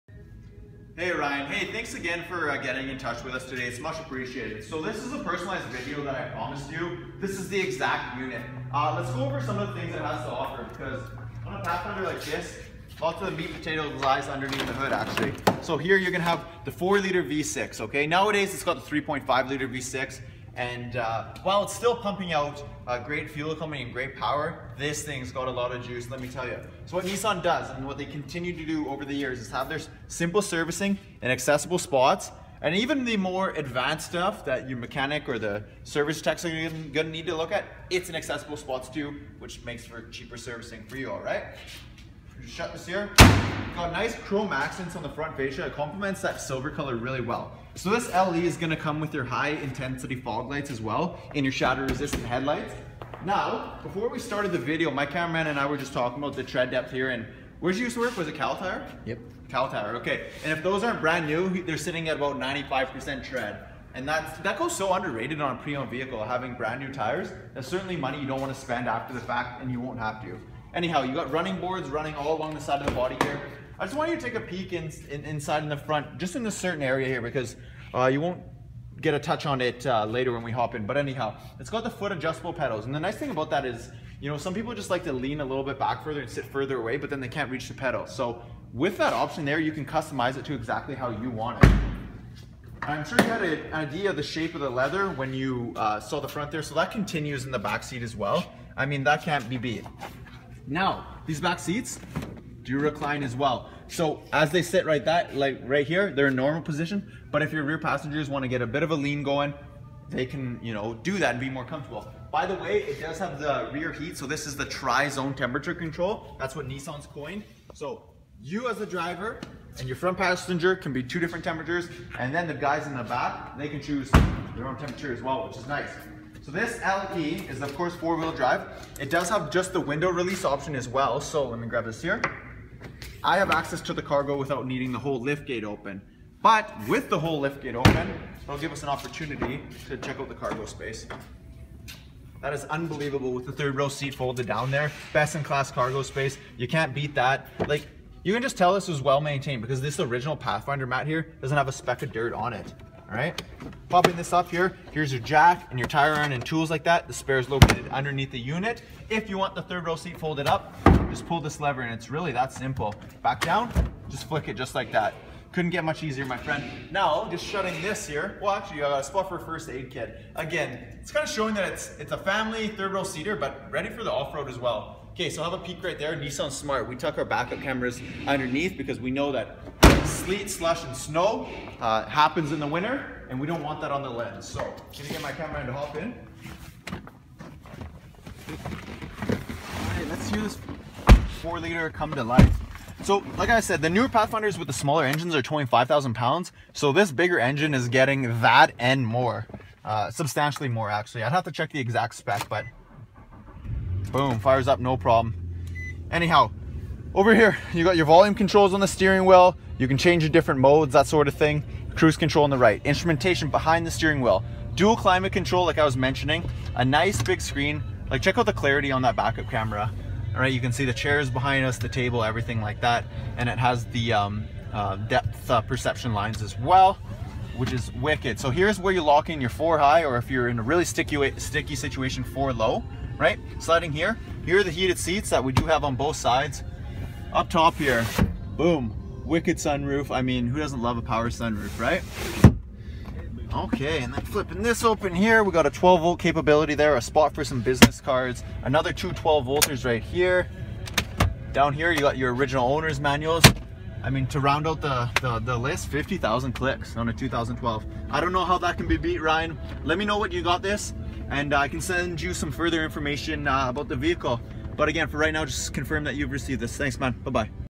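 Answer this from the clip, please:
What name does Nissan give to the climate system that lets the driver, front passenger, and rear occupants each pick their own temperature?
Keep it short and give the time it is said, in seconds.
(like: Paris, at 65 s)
tri-zone temperature control, at 114 s.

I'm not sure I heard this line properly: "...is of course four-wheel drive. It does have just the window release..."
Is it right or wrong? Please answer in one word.
right.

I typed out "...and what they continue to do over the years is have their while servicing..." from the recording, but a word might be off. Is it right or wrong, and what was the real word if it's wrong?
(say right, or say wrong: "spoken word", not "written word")
wrong: "simple", not "while".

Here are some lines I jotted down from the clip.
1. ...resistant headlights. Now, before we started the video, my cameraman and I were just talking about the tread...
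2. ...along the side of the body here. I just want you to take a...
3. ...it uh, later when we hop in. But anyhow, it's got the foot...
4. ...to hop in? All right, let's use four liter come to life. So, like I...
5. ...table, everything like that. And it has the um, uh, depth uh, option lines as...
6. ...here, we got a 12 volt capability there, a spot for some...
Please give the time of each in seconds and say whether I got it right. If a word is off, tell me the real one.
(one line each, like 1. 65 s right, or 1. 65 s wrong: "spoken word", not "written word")
1. 51 s right
2. 72 s right
3. 79 s right
4. 185 s right
5. 221 s wrong: "perception", not "option"
6. 245 s right.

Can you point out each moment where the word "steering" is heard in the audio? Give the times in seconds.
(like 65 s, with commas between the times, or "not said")
208 s, 213 s.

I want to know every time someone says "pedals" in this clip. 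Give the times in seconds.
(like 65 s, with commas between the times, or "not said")
82 s, 87 s.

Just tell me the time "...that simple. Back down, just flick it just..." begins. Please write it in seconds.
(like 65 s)
162 s.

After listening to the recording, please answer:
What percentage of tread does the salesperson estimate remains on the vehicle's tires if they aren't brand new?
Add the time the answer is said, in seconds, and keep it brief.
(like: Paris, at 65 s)
95%, at 62 s.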